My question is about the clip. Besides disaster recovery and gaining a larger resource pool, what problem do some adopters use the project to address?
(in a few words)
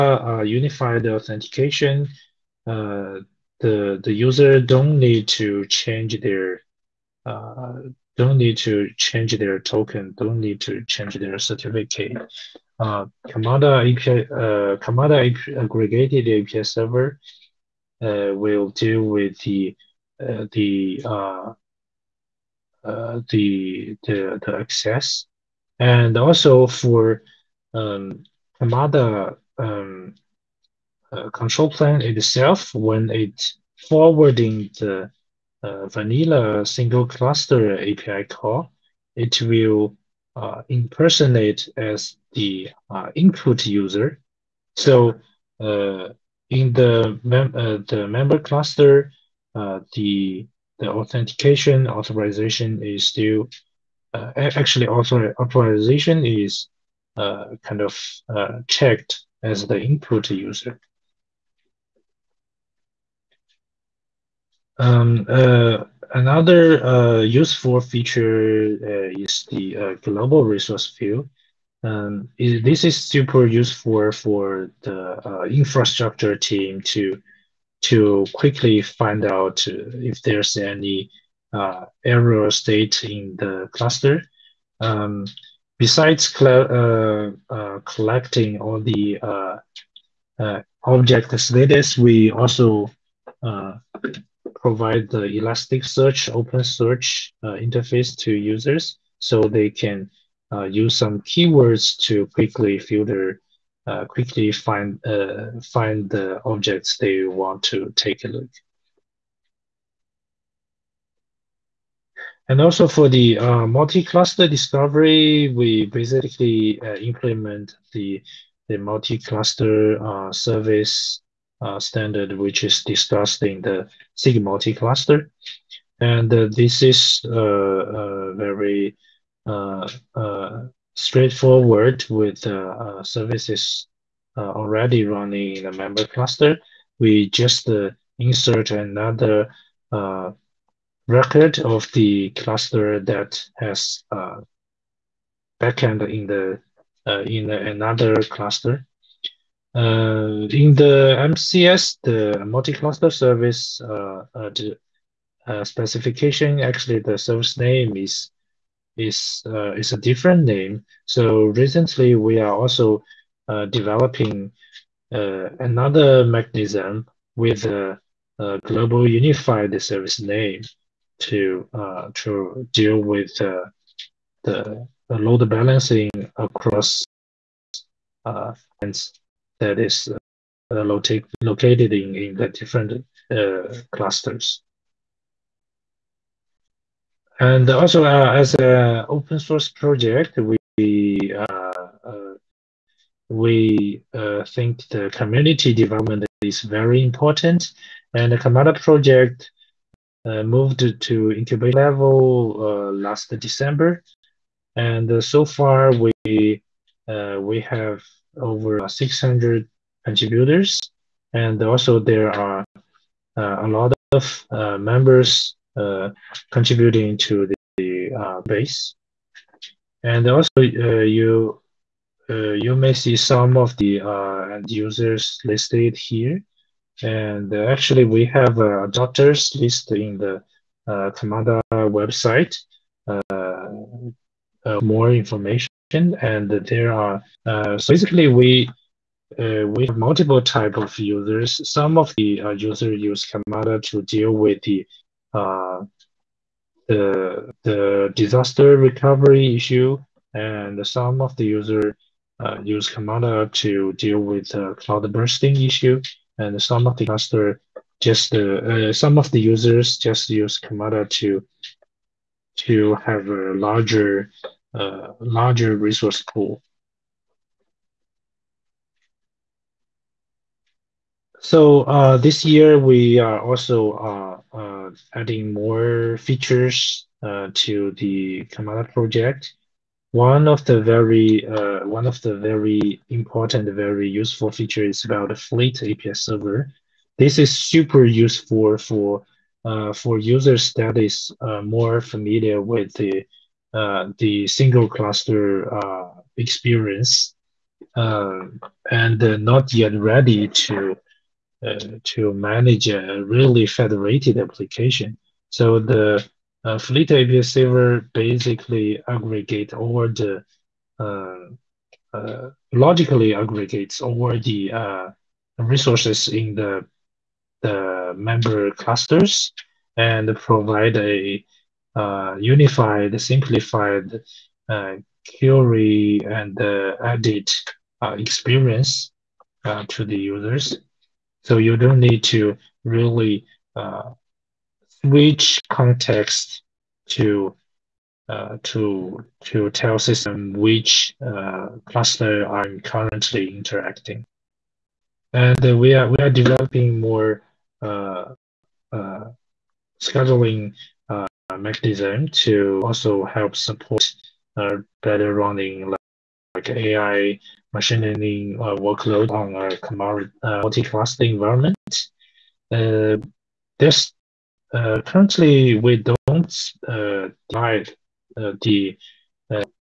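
cloud bursting.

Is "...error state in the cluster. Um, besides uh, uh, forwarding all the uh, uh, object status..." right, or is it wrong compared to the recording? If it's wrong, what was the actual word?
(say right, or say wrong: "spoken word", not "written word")
wrong: "collecting", not "forwarding".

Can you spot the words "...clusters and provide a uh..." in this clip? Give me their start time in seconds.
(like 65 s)
318 s.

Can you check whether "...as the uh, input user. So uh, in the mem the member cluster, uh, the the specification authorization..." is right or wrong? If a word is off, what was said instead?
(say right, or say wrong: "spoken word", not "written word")
wrong: "authentication", not "specification".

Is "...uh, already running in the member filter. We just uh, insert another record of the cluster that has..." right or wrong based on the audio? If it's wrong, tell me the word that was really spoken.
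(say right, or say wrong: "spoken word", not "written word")
wrong: "cluster", not "filter".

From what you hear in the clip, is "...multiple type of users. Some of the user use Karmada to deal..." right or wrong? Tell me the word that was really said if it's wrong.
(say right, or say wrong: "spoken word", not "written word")
right.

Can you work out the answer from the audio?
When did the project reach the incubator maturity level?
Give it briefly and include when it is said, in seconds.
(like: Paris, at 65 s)
last December, at 202 s.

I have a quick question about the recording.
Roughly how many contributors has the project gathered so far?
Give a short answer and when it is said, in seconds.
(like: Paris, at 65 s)
over 600, at 208 s.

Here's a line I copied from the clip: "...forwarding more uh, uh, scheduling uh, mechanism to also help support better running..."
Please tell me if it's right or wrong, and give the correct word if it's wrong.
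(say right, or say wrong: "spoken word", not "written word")
wrong: "developing", not "forwarding".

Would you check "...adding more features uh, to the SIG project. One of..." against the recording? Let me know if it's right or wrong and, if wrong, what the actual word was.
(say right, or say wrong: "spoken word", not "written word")
wrong: "Karmada", not "SIG".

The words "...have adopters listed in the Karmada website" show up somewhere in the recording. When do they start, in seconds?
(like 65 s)
228 s.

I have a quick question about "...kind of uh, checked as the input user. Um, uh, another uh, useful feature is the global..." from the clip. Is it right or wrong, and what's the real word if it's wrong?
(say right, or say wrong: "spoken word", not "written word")
right.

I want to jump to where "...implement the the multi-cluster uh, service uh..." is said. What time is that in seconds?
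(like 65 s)
116 s.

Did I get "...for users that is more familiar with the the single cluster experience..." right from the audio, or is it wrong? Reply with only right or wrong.
right.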